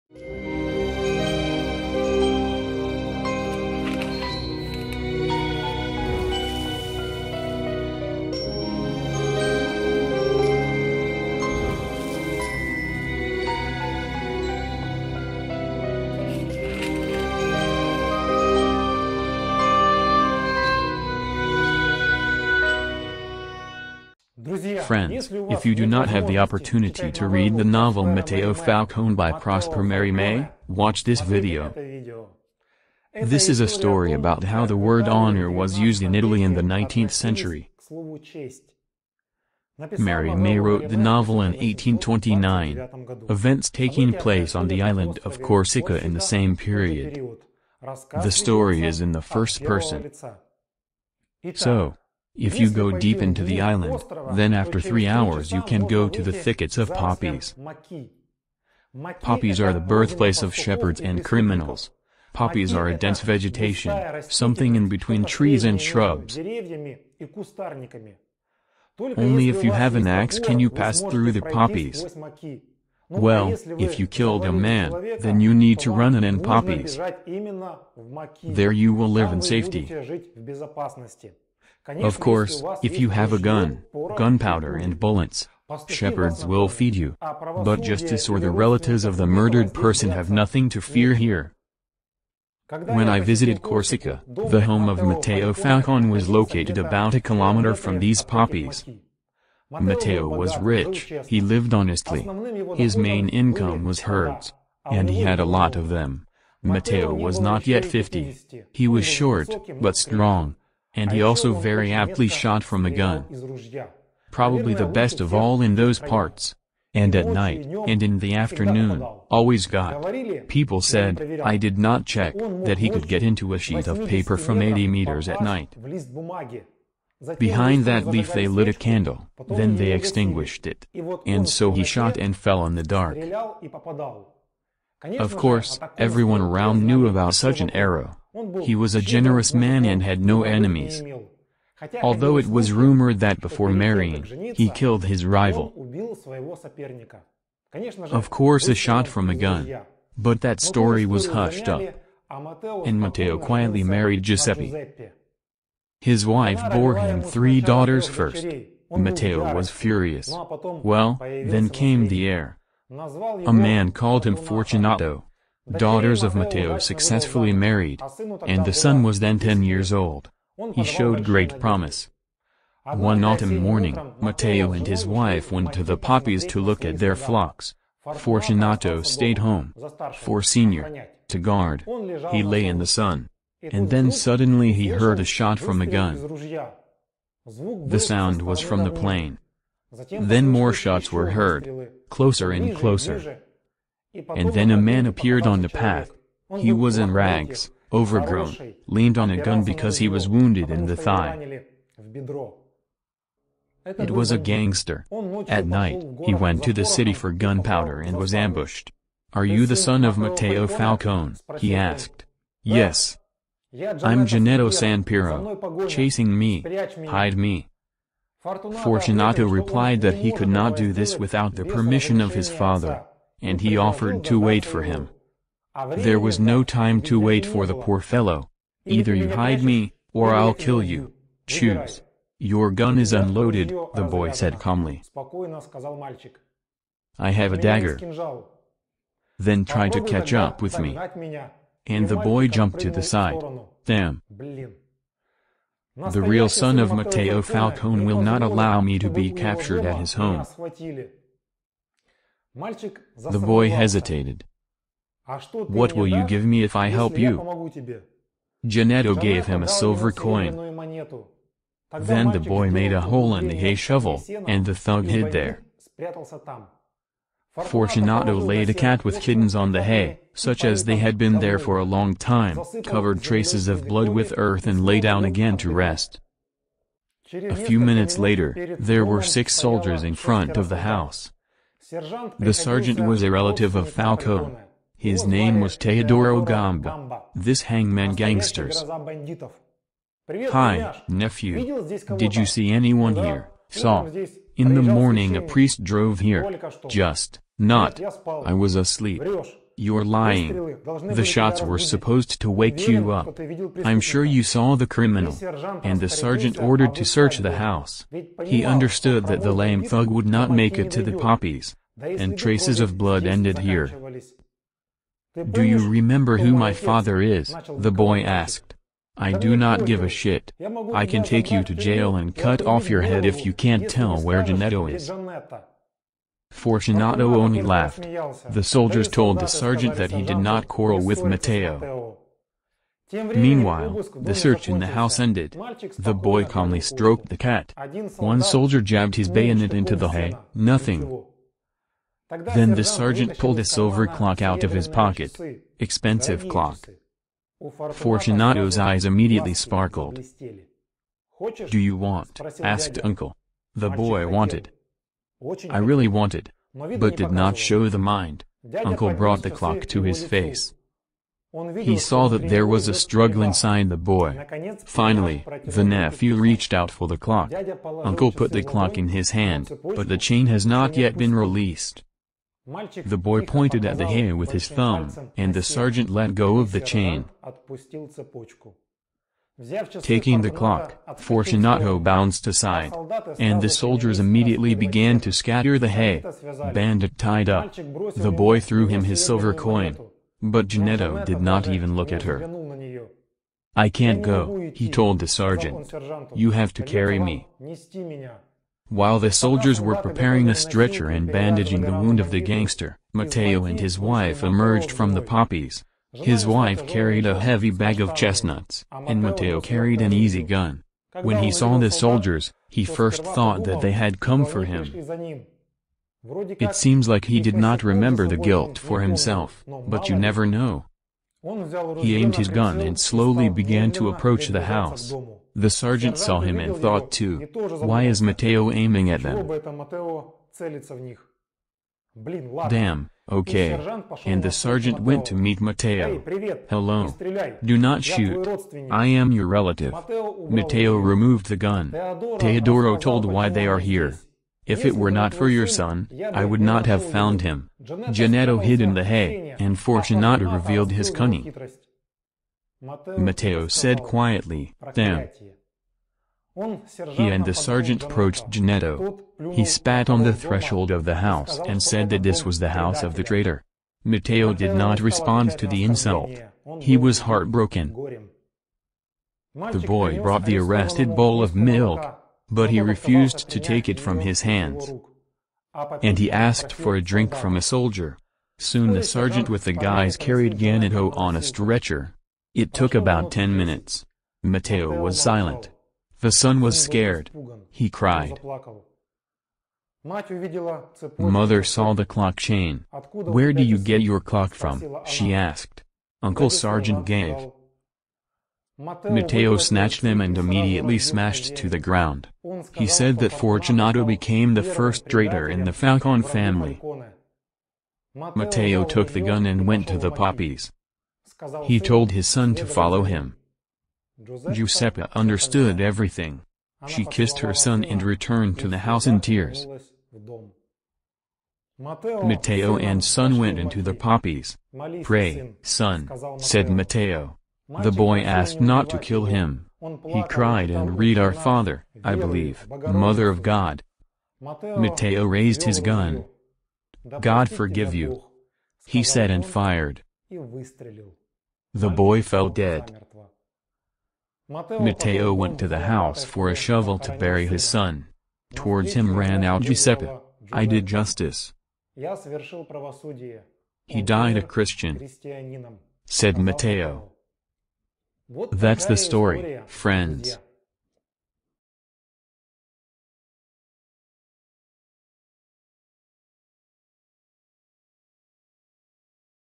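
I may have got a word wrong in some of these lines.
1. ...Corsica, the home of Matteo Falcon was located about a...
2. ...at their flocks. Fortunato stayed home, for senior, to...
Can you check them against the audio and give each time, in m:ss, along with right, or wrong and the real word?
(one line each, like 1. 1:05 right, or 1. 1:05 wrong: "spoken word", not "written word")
1. 1:33 right
2. 2:56 right.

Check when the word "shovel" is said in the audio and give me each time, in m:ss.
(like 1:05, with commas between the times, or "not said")
4:23, 9:06.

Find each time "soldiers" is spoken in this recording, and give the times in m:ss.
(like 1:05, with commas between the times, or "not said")
4:39, 5:28, 5:38, 6:23, 6:39, 6:51, 7:57.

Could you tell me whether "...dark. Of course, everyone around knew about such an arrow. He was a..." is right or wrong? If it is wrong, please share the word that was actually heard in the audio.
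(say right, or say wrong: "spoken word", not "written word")
right.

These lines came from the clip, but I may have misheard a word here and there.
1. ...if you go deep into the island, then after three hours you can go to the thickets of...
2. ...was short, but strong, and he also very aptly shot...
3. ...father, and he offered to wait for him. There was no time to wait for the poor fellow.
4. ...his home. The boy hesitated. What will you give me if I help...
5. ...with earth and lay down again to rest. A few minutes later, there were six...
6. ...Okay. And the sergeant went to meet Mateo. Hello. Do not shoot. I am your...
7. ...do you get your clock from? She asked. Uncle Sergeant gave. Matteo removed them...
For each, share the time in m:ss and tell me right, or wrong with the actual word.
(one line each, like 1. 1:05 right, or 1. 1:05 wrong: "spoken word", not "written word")
1. 0:52 right
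2. 1:48 right
3. 3:42 right
4. 4:09 right
5. 4:34 right
6. 7:13 right
7. 8:13 wrong: "snatched", not "removed".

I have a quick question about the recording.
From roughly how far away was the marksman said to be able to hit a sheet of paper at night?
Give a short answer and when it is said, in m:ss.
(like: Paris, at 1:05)
80 meters, at 2:04.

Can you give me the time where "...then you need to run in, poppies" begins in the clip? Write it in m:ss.
1:15.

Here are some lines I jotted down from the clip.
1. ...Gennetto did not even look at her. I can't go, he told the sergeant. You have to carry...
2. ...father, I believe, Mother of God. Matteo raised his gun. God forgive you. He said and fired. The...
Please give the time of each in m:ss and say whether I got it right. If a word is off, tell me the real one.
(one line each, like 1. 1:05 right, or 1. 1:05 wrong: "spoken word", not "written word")
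1. 6:30 right
2. 8:51 right.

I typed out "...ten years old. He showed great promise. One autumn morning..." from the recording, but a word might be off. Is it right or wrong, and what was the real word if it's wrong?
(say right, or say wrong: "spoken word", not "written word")
right.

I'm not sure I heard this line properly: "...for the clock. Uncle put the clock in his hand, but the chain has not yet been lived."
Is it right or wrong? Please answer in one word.
wrong.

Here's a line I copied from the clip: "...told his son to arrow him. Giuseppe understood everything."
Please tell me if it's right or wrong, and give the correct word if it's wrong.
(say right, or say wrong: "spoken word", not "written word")
wrong: "follow", not "arrow".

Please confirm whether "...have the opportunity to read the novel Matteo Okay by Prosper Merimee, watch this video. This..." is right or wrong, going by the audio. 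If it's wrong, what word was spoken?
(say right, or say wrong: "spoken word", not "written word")
wrong: "Falcone", not "Okay".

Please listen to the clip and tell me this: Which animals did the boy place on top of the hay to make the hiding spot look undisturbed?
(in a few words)
Cat with kittens.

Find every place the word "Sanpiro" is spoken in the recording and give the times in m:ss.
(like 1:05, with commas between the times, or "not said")
3:34.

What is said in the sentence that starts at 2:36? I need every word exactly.
His wife bore him three daughters first.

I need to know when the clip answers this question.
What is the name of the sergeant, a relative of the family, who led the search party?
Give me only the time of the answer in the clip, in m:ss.
4:45.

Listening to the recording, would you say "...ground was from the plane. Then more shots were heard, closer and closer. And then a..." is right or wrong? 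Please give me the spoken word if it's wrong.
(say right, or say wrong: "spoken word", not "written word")
wrong: "sound", not "ground".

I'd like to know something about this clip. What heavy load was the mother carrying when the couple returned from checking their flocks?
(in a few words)
Bag of chestnuts.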